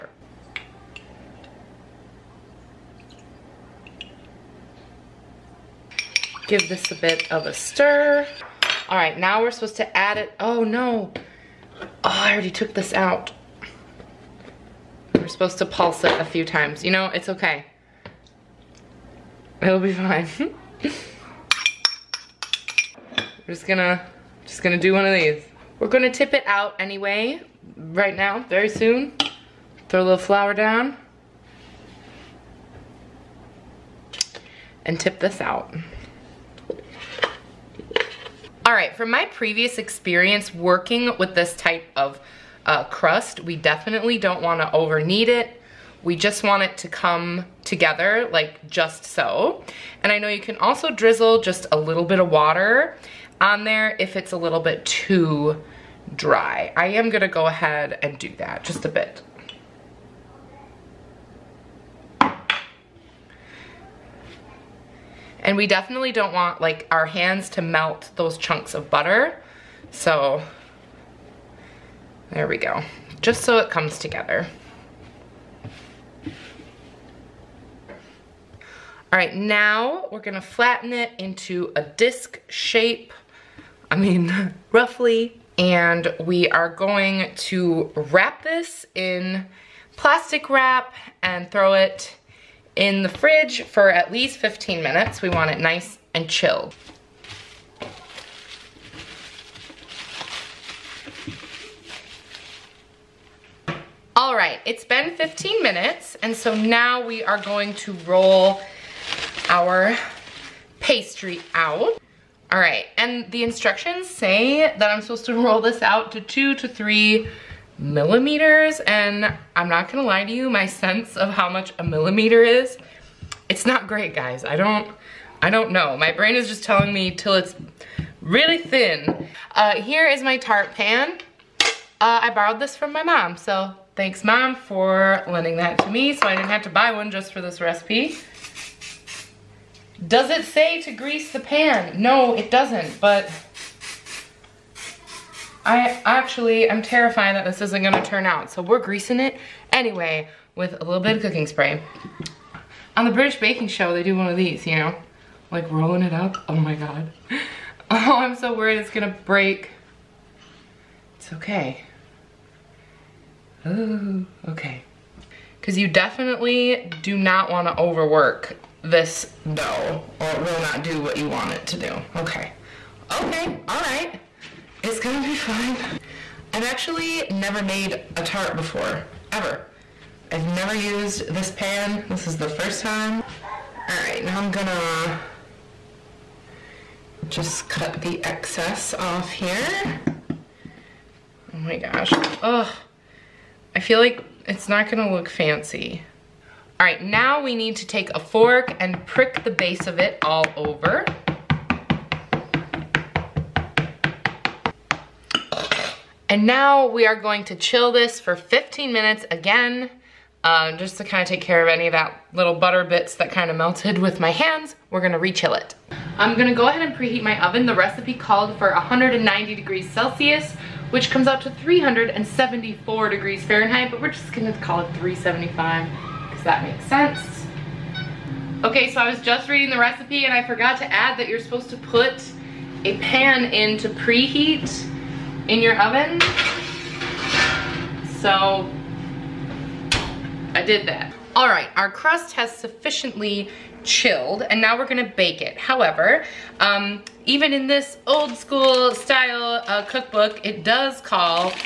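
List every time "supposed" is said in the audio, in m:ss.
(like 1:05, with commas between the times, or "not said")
0:09, 0:15, 1:55, 3:51.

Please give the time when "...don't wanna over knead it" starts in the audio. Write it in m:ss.
0:44.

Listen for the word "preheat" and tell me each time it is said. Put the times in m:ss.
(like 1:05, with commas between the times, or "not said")
3:36, 3:53.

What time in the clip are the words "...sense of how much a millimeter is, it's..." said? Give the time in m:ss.
2:00.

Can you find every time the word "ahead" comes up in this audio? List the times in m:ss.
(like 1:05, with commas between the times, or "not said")
0:57, 3:36.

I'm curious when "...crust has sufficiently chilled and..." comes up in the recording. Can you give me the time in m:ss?
4:01.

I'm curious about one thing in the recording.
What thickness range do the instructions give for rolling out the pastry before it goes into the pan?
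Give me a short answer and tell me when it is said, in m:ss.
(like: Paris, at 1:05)
2 to 3 millimeters, at 1:56.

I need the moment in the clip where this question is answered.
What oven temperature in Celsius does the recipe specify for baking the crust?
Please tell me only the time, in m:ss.
3:38.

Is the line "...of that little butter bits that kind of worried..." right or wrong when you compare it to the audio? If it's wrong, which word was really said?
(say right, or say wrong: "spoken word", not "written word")
wrong: "melted", not "worried".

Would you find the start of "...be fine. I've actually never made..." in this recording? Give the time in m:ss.
2:55.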